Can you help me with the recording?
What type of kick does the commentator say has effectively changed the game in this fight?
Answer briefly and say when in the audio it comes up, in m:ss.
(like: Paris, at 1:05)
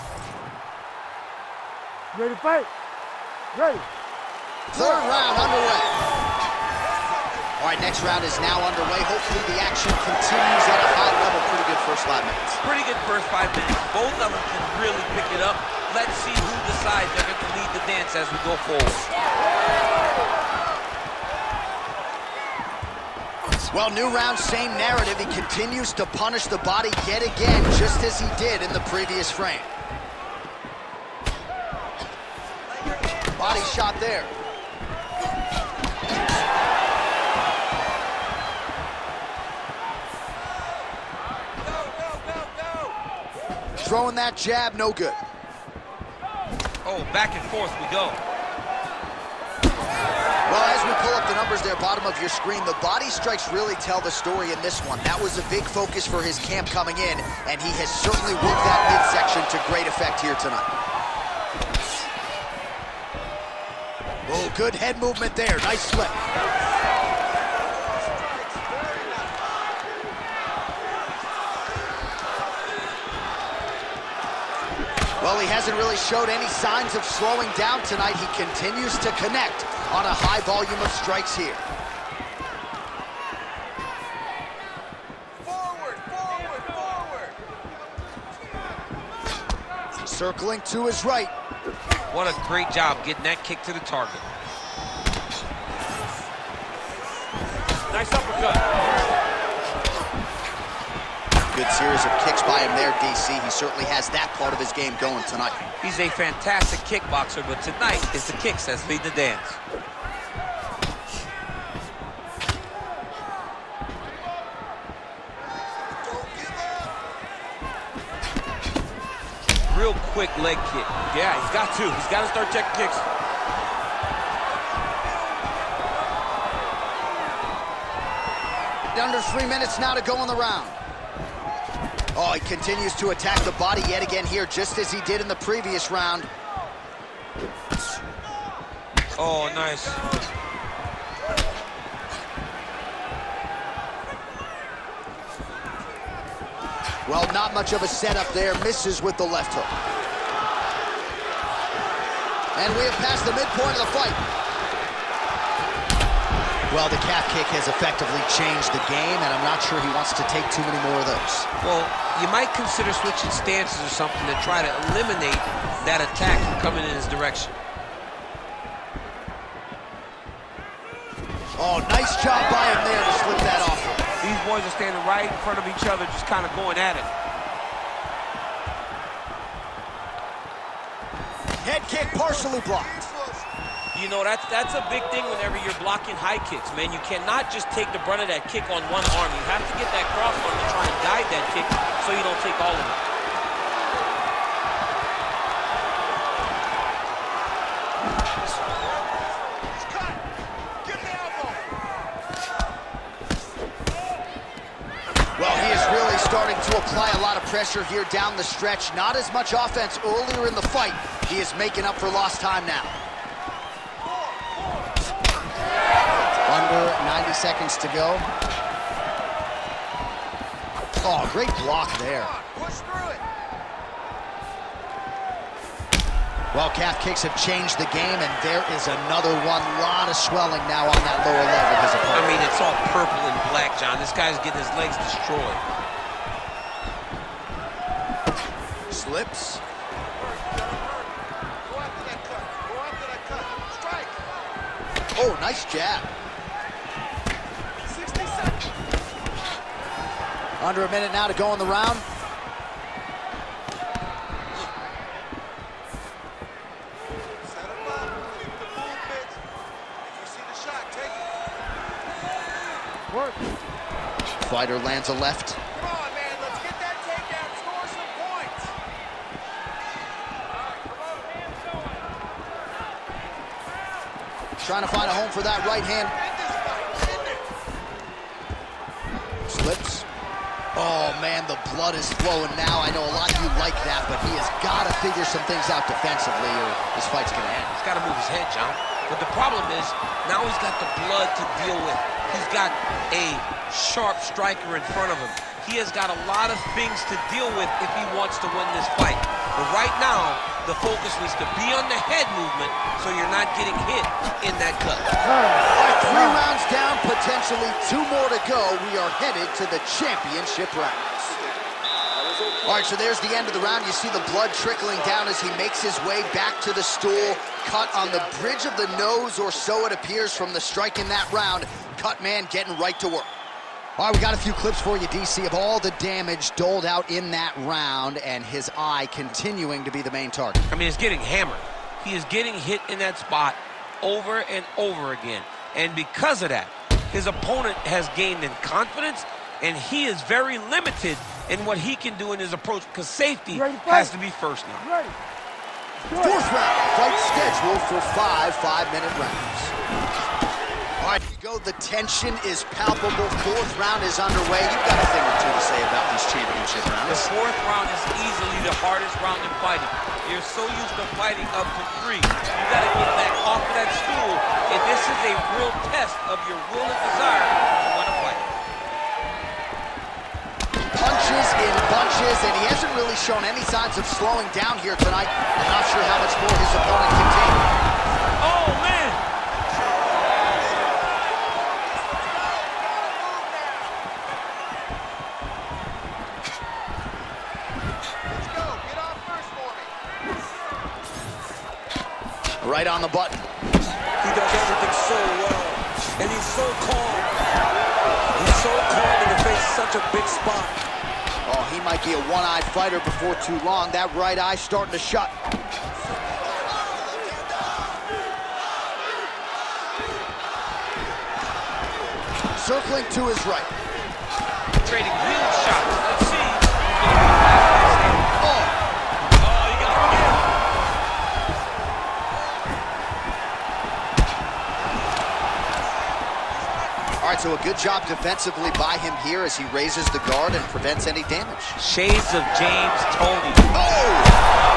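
Calf kick, at 2:36.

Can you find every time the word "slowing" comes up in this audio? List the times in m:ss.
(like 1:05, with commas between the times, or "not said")
1:17, 6:14.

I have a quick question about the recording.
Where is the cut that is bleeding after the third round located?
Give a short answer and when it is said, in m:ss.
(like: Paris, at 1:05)
Bridge of the nose, at 5:18.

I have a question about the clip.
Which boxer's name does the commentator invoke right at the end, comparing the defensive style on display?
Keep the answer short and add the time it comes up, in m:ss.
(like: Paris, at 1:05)
James Toney, at 7:12.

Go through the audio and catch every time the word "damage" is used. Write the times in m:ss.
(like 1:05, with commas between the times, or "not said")
5:25, 7:11.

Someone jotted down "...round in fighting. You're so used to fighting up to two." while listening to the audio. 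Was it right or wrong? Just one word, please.
wrong.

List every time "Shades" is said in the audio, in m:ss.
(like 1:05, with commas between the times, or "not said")
7:11.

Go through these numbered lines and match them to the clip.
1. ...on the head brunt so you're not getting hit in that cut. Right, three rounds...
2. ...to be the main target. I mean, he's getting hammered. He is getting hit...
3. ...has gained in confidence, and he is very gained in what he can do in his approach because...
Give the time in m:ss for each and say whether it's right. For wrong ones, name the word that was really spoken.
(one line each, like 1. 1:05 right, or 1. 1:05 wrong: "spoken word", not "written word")
1. 5:01 wrong: "movement", not "brunt"
2. 5:29 right
3. 5:37 wrong: "limited", not "gained".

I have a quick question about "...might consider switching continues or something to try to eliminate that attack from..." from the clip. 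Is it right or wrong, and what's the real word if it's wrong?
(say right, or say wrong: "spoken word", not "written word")
wrong: "stances", not "continues".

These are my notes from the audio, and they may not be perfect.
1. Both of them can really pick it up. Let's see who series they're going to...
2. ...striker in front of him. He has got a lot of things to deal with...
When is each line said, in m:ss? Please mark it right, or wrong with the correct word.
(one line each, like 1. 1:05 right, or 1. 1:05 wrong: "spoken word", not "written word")
1. 0:13 wrong: "decides", not "series"
2. 4:54 right.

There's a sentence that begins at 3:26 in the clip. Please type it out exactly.
starting to apply a lot of pressure here down the stretch.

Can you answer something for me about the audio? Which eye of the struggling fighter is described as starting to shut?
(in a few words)
Right eye.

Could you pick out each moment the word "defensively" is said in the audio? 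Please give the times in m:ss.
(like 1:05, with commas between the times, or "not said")
4:45, 7:08.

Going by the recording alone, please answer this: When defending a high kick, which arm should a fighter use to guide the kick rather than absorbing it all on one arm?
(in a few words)
Cross arm.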